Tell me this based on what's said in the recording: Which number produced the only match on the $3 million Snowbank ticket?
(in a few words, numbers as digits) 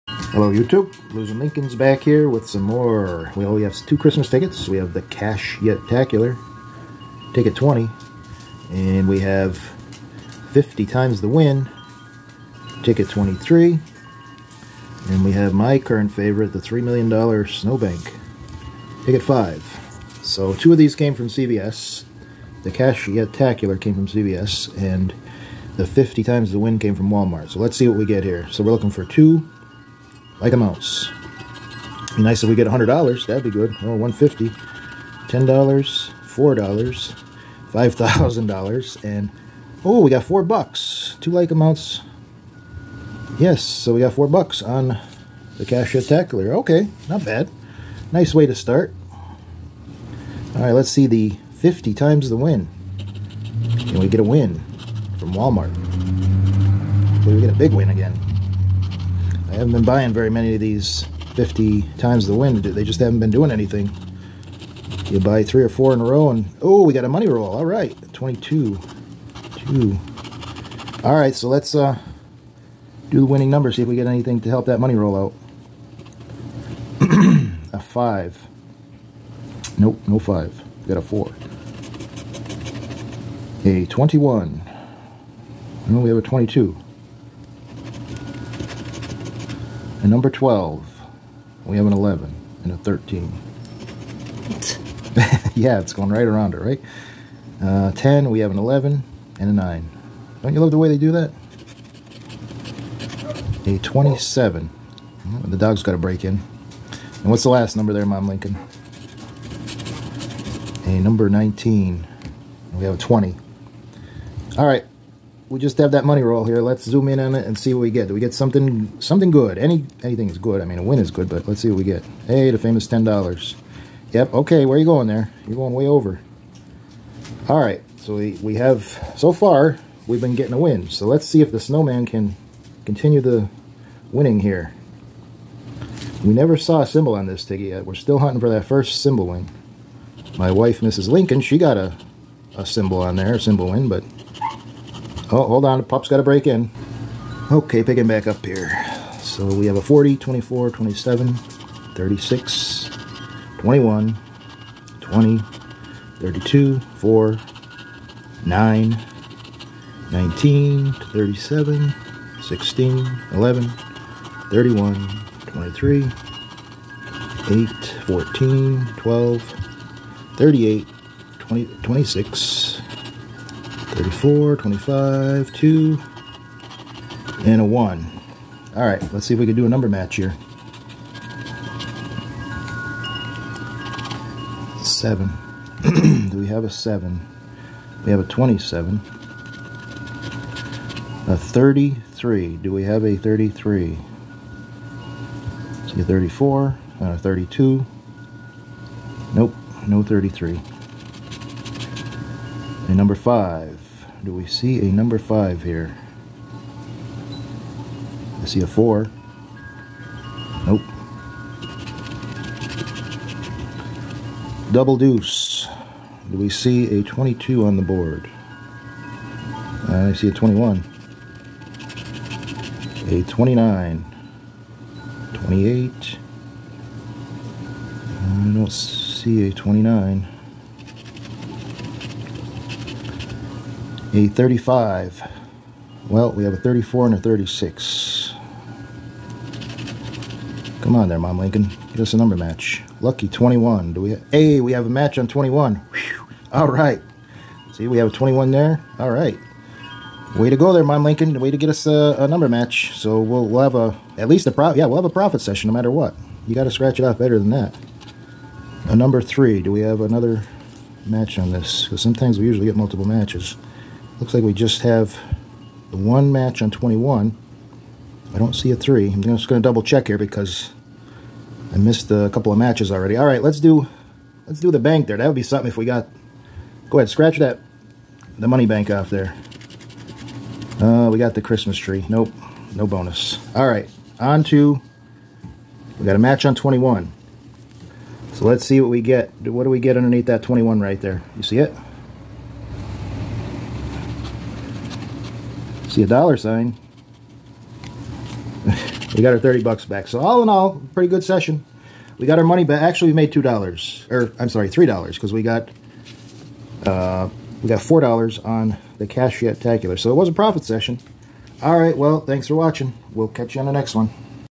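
21.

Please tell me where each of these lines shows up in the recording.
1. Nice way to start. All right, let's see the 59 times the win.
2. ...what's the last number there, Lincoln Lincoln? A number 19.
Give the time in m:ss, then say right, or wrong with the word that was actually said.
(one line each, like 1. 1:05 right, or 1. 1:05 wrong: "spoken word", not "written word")
1. 0:48 wrong: "50", not "59"
2. 1:47 wrong: "Mom", not "Lincoln".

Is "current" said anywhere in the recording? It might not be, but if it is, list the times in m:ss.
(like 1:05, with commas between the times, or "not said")
0:15.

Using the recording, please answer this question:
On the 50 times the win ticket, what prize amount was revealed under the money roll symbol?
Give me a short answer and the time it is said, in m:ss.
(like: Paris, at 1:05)
$10, at 2:02.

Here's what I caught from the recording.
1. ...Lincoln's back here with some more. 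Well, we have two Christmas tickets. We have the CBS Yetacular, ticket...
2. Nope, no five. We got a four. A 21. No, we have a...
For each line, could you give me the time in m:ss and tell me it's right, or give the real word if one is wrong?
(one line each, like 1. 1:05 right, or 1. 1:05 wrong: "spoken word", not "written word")
1. 0:01 wrong: "Cash", not "CBS"
2. 1:19 right.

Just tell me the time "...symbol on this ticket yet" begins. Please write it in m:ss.
2:16.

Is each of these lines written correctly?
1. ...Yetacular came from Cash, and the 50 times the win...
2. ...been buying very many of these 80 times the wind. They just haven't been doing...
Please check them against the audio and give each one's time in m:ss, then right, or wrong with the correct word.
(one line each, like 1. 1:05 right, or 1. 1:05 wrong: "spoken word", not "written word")
1. 0:23 wrong: "CBS", not "Cash"
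2. 0:59 wrong: "50", not "80".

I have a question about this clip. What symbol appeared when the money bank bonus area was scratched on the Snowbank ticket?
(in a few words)
Christmas tree.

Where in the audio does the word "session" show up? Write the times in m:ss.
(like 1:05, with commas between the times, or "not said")
4:15, 5:01, 5:10.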